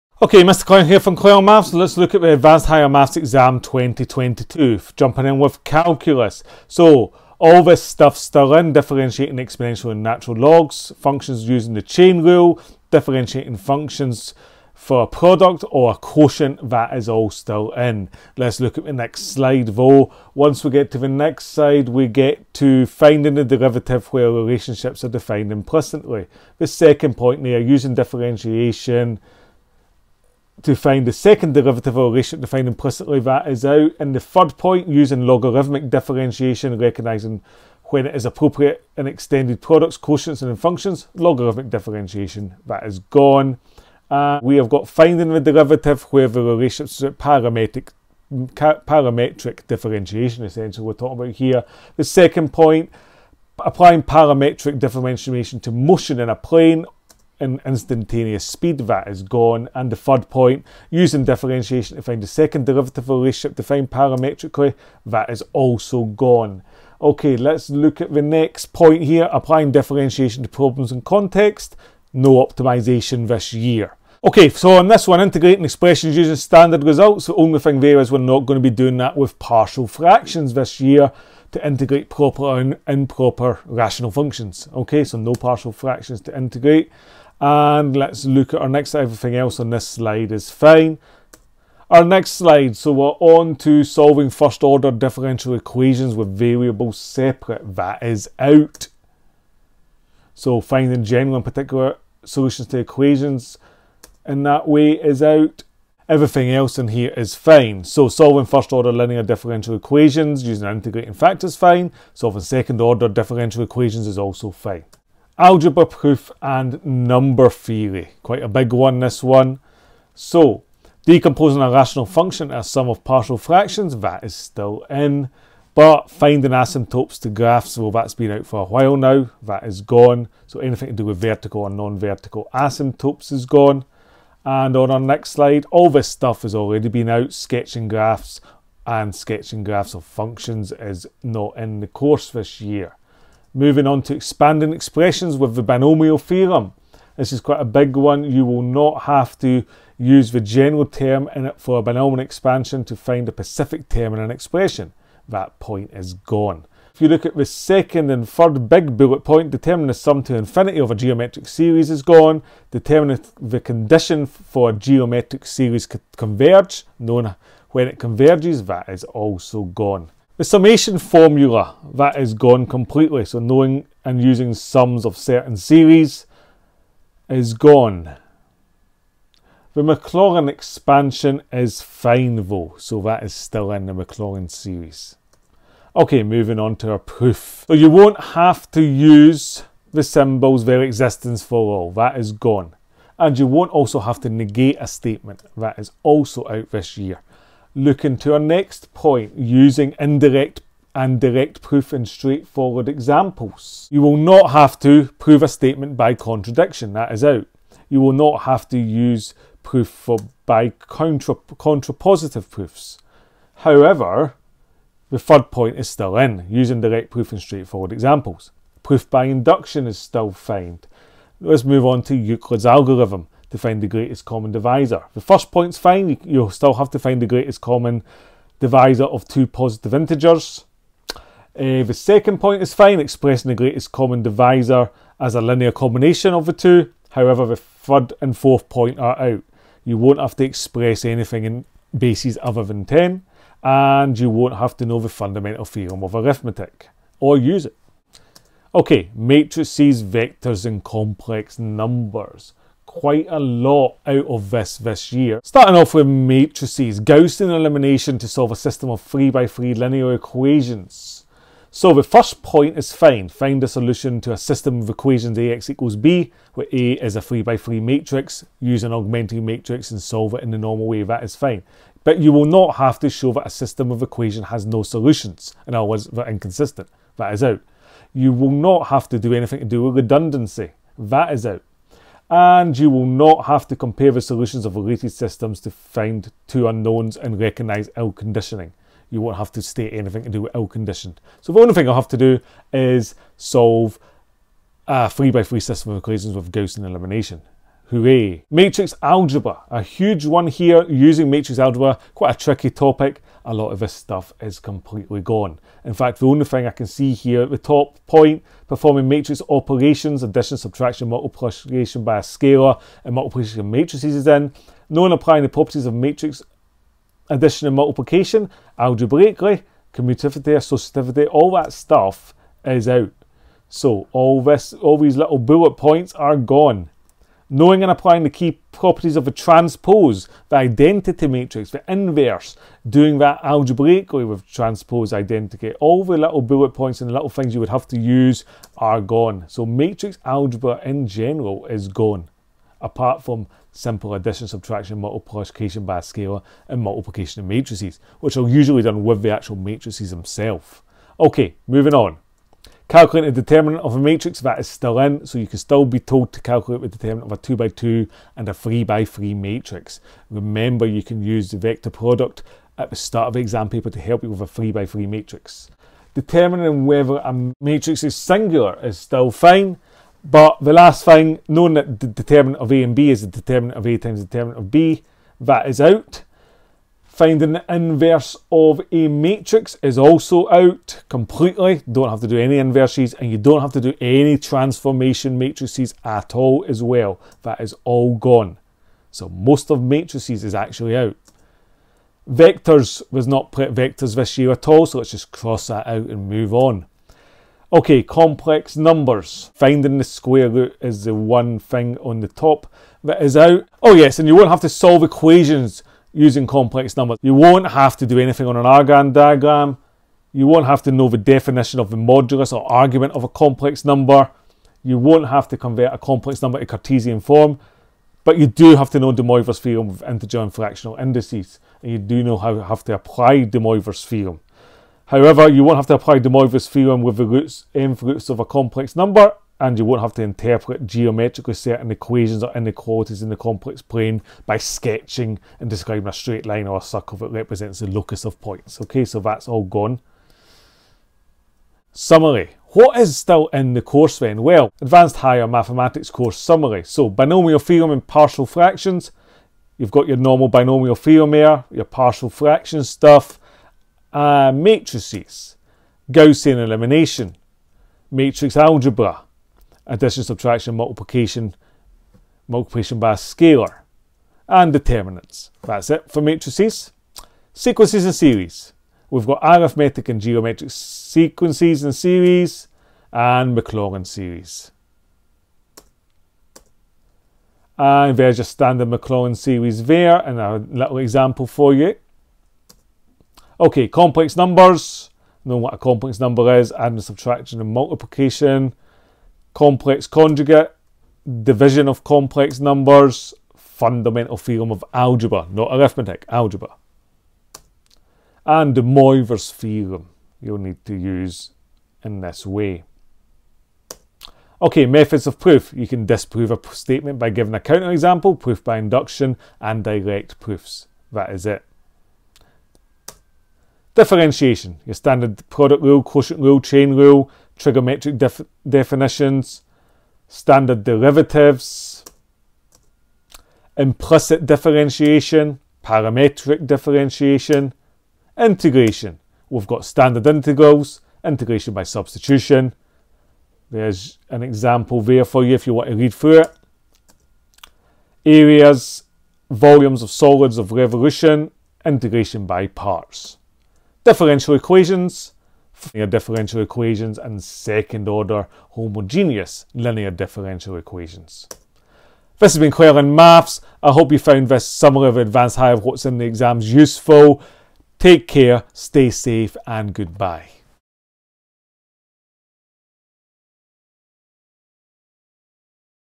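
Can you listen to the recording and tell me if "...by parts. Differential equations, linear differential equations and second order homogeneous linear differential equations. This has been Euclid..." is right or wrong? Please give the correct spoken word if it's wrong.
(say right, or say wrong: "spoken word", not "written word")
wrong: "Clelland", not "Euclid".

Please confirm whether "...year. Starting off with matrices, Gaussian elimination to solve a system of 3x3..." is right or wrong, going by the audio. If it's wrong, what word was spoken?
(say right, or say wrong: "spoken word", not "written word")
right.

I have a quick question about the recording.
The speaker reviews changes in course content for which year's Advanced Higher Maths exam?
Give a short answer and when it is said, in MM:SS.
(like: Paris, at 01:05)
2022, at 00:03.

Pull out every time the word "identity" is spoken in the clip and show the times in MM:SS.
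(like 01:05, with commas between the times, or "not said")
05:30, 05:35.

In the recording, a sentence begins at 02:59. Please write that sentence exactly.
The Maclaurin expansion is fine though, so that is still in the Maclaurin series.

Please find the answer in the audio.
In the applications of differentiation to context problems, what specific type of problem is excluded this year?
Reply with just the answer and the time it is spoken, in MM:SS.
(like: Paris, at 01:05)
optimization, at 01:12.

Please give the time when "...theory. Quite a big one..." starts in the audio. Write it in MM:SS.
01:57.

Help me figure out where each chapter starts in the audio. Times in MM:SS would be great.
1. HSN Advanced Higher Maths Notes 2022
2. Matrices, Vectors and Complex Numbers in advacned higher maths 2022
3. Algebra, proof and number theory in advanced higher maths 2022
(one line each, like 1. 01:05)
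1. 07:25
2. 04:10
3. 01:54.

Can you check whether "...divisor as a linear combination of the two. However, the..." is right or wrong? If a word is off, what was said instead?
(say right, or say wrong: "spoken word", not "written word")
right.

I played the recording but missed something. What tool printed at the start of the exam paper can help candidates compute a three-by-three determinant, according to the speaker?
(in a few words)
vector product.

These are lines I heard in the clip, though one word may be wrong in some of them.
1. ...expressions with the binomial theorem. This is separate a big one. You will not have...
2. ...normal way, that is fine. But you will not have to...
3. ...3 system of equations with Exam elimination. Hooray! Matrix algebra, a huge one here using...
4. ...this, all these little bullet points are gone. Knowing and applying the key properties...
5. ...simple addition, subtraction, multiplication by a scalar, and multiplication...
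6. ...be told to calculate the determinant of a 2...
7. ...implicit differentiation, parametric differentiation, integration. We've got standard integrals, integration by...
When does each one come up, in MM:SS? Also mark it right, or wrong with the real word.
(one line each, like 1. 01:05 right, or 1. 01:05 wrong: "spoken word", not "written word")
1. 02:24 wrong: "quite", not "separate"
2. 04:30 right
3. 04:55 wrong: "Gaussian", not "Exam"
4. 05:24 right
5. 05:43 right
6. 05:55 right
7. 08:43 right.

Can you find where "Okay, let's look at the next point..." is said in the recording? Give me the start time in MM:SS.
01:07.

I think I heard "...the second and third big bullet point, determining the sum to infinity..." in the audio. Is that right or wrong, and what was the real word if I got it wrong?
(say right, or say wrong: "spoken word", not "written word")
right.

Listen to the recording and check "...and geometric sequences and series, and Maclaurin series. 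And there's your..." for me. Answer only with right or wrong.
right.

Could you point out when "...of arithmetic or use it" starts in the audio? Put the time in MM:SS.
04:06.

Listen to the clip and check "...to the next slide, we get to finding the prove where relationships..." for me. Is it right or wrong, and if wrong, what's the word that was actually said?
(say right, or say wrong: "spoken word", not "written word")
wrong: "derivative", not "prove".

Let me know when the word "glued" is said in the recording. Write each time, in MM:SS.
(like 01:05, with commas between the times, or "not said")
not said.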